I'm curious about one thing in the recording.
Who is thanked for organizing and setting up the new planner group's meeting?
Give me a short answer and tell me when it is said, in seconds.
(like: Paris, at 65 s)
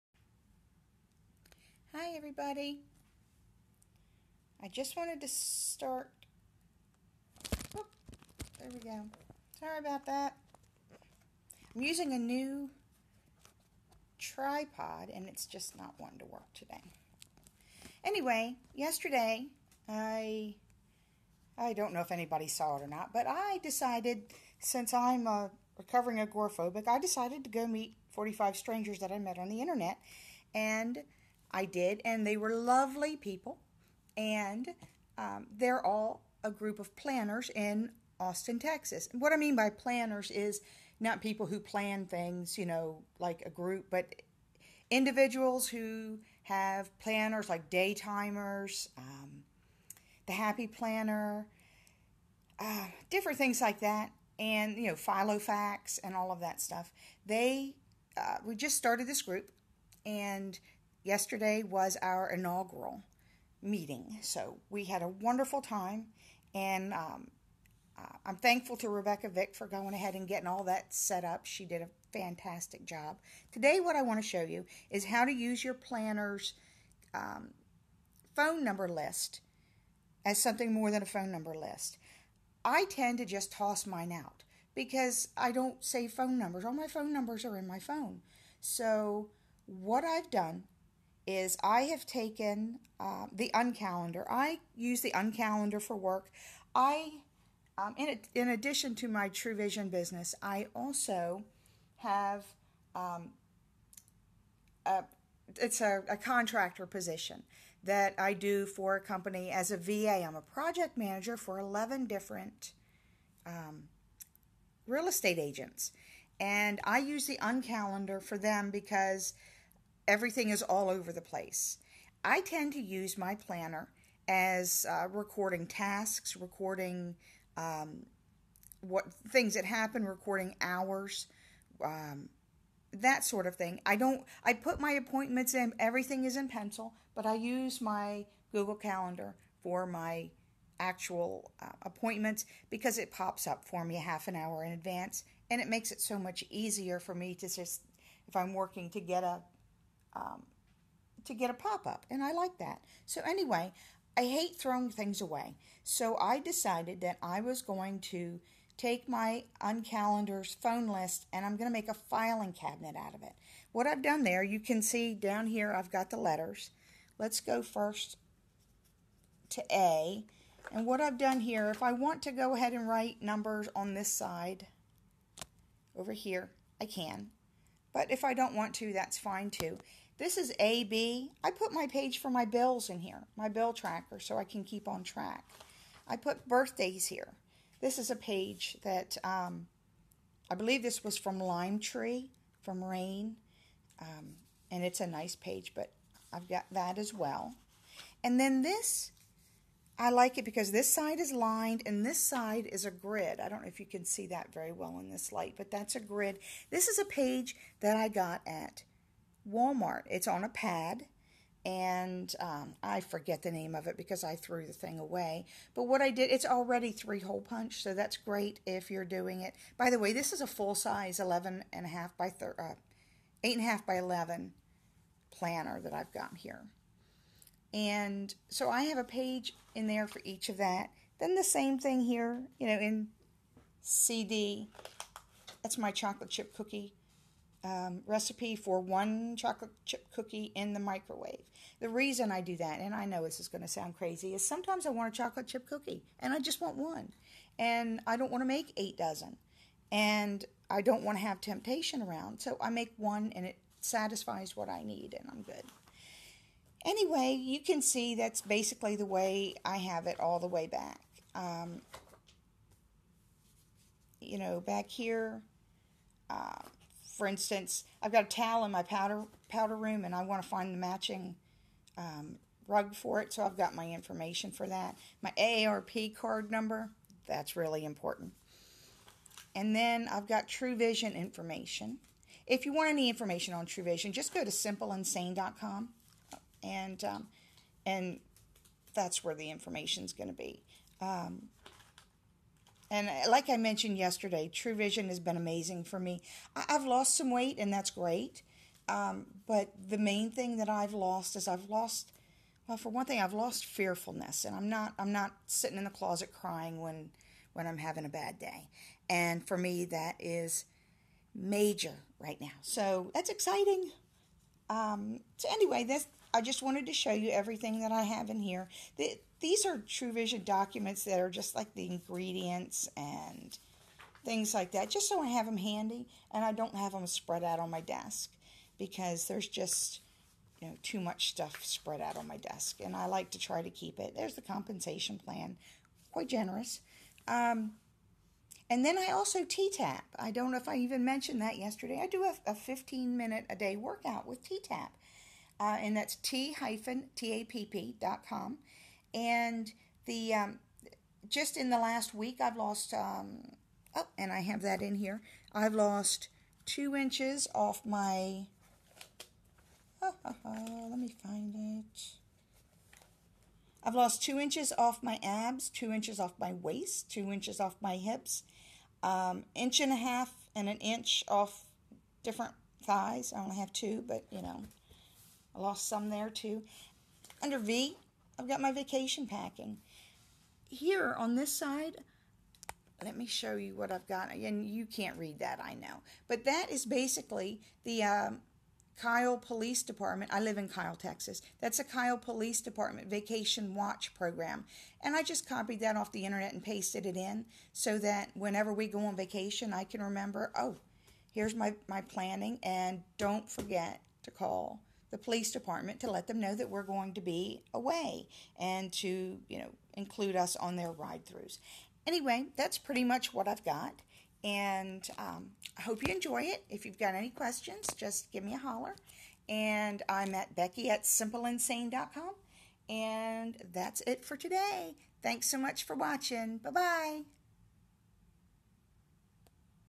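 Rebecca Vick, at 68 s.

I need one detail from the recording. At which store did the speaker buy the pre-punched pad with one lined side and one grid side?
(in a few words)
Walmart.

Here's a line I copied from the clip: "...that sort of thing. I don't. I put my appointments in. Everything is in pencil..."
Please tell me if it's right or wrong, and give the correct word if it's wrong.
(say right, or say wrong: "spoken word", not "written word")
right.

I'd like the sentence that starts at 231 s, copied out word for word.
Then the same thing here, you know, in CD.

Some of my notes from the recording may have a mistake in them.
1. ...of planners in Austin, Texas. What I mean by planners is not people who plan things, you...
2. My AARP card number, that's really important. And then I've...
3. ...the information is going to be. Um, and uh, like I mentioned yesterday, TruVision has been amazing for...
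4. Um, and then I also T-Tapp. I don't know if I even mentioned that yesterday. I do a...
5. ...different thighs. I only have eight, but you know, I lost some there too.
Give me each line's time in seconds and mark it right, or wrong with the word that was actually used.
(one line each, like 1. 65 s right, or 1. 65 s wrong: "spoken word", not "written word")
1. 36 s right
2. 275 s right
3. 289 s right
4. 337 s right
5. 372 s wrong: "two", not "eight".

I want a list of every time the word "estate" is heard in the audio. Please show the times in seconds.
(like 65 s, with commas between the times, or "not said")
115 s.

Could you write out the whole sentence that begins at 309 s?
And for me, that is major right now.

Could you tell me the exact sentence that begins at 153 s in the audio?
So anyway, I hate throwing things away.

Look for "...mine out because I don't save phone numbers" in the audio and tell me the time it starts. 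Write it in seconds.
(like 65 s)
83 s.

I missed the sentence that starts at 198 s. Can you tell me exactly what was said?
And then this I like it because this side is lined and this side is a grid.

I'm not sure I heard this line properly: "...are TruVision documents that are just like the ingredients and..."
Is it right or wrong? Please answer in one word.
right.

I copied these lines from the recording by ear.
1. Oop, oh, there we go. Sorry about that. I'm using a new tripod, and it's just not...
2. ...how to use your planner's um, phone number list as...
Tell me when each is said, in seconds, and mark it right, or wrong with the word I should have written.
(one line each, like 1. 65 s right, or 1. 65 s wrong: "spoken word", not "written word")
1. 7 s right
2. 75 s right.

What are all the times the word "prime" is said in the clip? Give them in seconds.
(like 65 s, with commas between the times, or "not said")
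not said.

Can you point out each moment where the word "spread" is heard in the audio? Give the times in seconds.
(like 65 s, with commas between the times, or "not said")
327 s, 331 s.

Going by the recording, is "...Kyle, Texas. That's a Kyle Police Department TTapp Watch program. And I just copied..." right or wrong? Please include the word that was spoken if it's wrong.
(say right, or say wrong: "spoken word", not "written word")
wrong: "Vacation", not "TTapp".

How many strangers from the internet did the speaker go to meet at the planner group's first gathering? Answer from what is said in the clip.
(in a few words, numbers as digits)
45.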